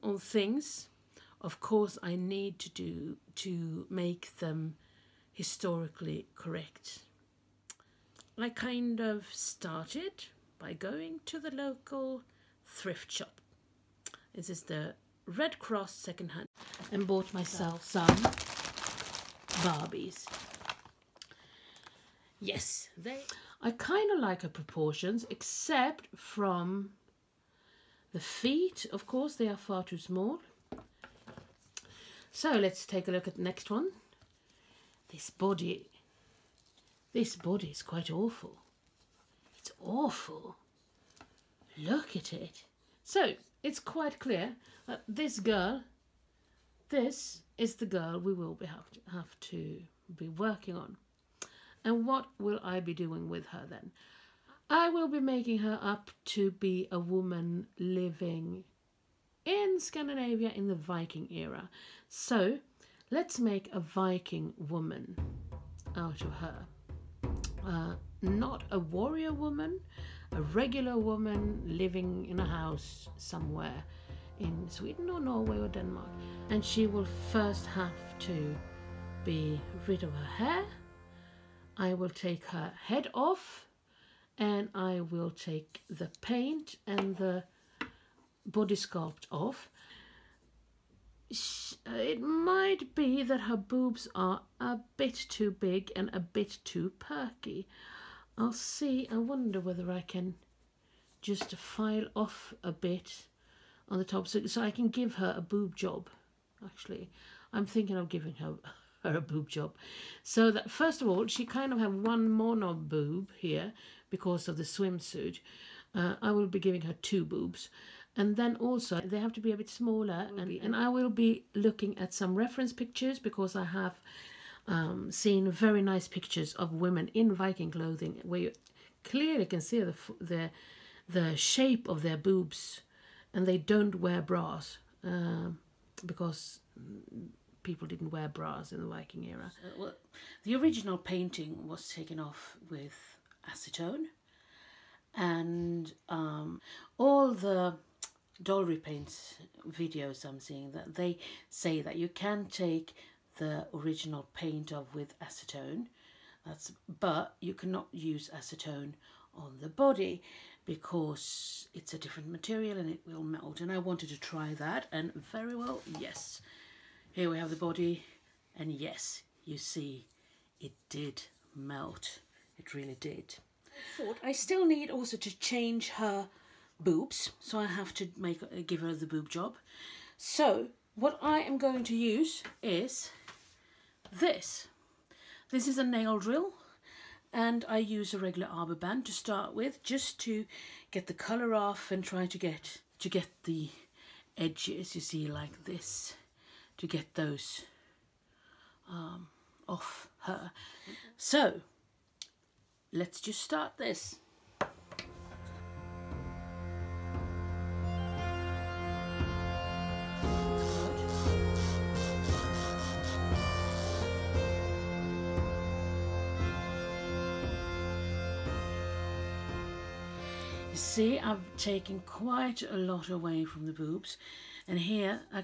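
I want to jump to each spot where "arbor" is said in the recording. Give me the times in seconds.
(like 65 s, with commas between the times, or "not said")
188 s.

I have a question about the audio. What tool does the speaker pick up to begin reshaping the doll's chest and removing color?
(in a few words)
Nail drill.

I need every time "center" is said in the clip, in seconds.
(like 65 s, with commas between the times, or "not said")
not said.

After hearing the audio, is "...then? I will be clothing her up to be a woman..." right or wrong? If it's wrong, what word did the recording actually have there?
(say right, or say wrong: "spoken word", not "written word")
wrong: "making", not "clothing".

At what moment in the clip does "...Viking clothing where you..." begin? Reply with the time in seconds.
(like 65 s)
127 s.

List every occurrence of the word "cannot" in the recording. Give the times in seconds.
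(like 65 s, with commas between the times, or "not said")
157 s.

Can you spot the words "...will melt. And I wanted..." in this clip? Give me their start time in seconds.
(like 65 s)
163 s.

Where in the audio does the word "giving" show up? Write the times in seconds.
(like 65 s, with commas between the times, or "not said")
108 s, 116 s.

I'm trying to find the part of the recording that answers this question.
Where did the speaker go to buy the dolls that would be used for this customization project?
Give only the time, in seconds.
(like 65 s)
15 s.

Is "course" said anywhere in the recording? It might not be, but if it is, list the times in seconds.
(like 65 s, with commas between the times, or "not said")
1 s, 29 s.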